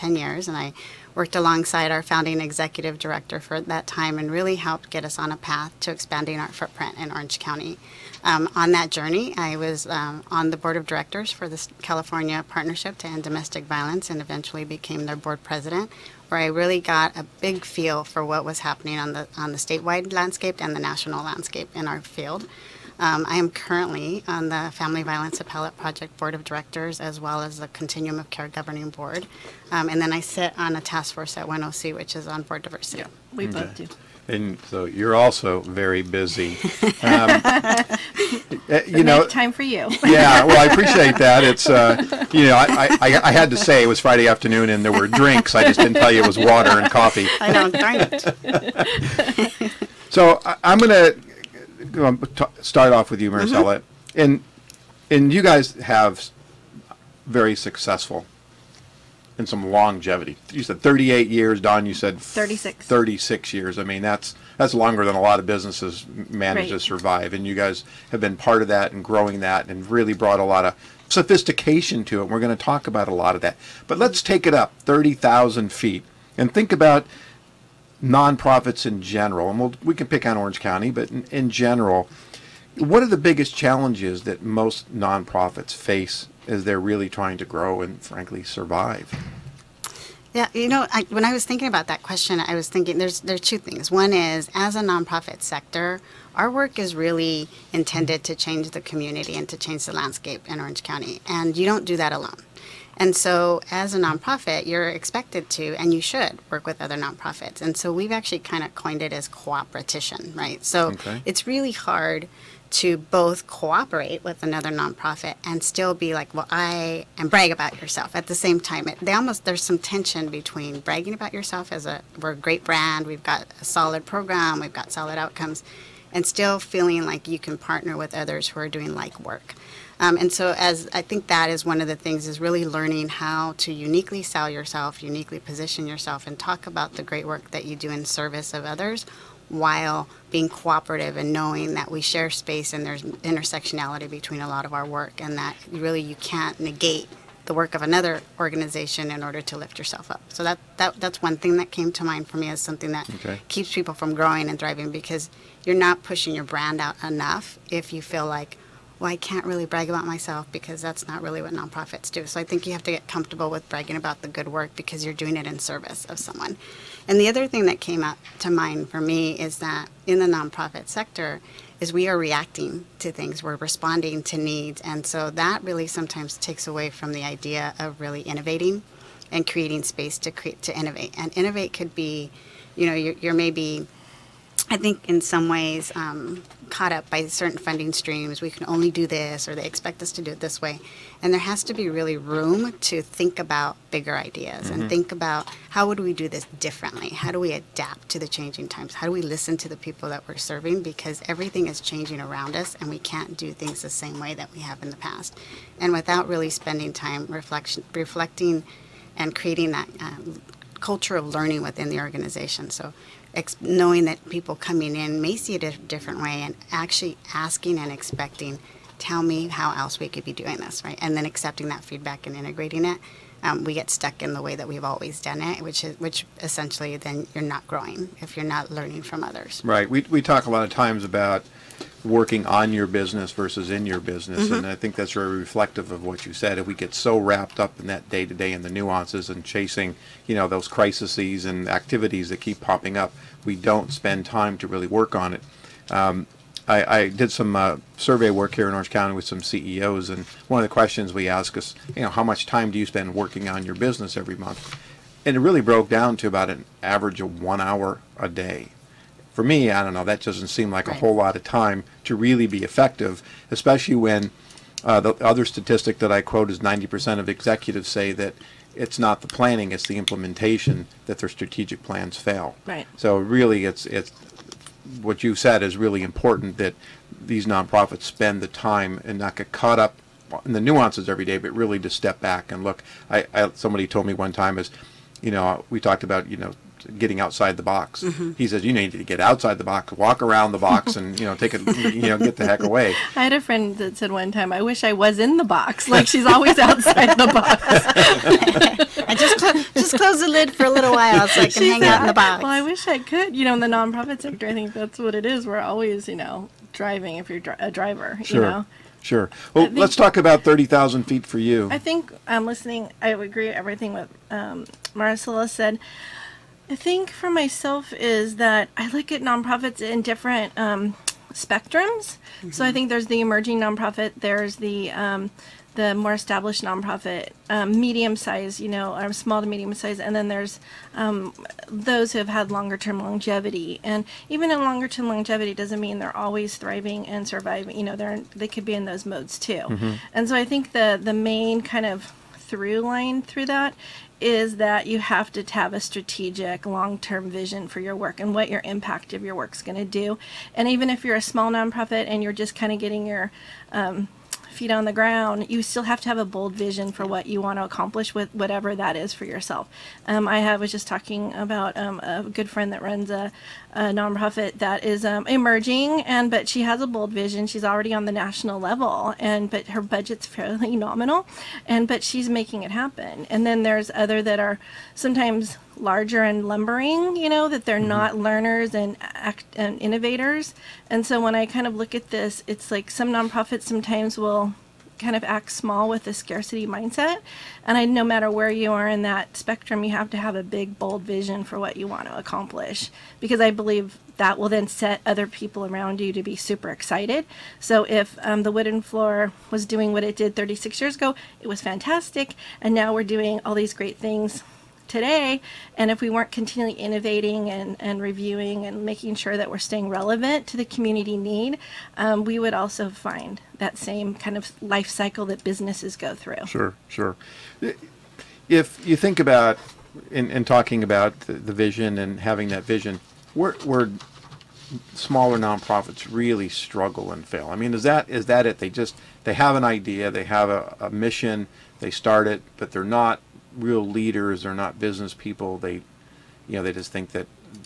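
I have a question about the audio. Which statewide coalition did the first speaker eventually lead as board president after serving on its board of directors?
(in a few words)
California Partnership to End Domestic Violence.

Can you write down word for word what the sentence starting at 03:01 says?
And innovate could be, you know, you're, you're maybe I think in some ways um, caught up by certain funding streams.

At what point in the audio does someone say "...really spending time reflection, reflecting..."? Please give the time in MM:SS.
03:26.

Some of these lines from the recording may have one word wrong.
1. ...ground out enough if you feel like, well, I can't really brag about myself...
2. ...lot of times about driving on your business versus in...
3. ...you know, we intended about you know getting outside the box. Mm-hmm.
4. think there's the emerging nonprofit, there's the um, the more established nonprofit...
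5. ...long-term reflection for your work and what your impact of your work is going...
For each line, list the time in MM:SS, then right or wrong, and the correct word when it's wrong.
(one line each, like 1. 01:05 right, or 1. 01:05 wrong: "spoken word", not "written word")
1. 02:36 wrong: "brand", not "ground"
2. 03:50 wrong: "working", not "driving"
3. 04:45 wrong: "talked", not "intended"
4. 05:22 right
5. 05:46 wrong: "vision", not "reflection".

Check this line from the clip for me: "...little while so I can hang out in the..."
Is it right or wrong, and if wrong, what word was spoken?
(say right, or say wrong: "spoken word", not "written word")
right.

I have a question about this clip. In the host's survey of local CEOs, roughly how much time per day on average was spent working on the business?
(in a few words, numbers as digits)
one hour.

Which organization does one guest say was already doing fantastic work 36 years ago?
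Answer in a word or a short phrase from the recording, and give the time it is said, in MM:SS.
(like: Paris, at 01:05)
The Wooden Floor, at 06:38.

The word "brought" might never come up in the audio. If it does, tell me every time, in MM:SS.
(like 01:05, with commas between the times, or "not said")
01:10.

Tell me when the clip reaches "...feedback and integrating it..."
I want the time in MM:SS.
03:41.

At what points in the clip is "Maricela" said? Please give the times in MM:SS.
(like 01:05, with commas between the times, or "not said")
00:53, 05:14.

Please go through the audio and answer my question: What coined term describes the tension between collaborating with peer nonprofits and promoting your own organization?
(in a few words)
cooperatition.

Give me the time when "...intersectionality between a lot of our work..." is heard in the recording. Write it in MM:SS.
02:23.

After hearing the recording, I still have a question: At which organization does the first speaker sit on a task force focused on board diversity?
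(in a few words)
1OC.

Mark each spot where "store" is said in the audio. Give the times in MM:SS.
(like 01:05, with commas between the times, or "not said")
not said.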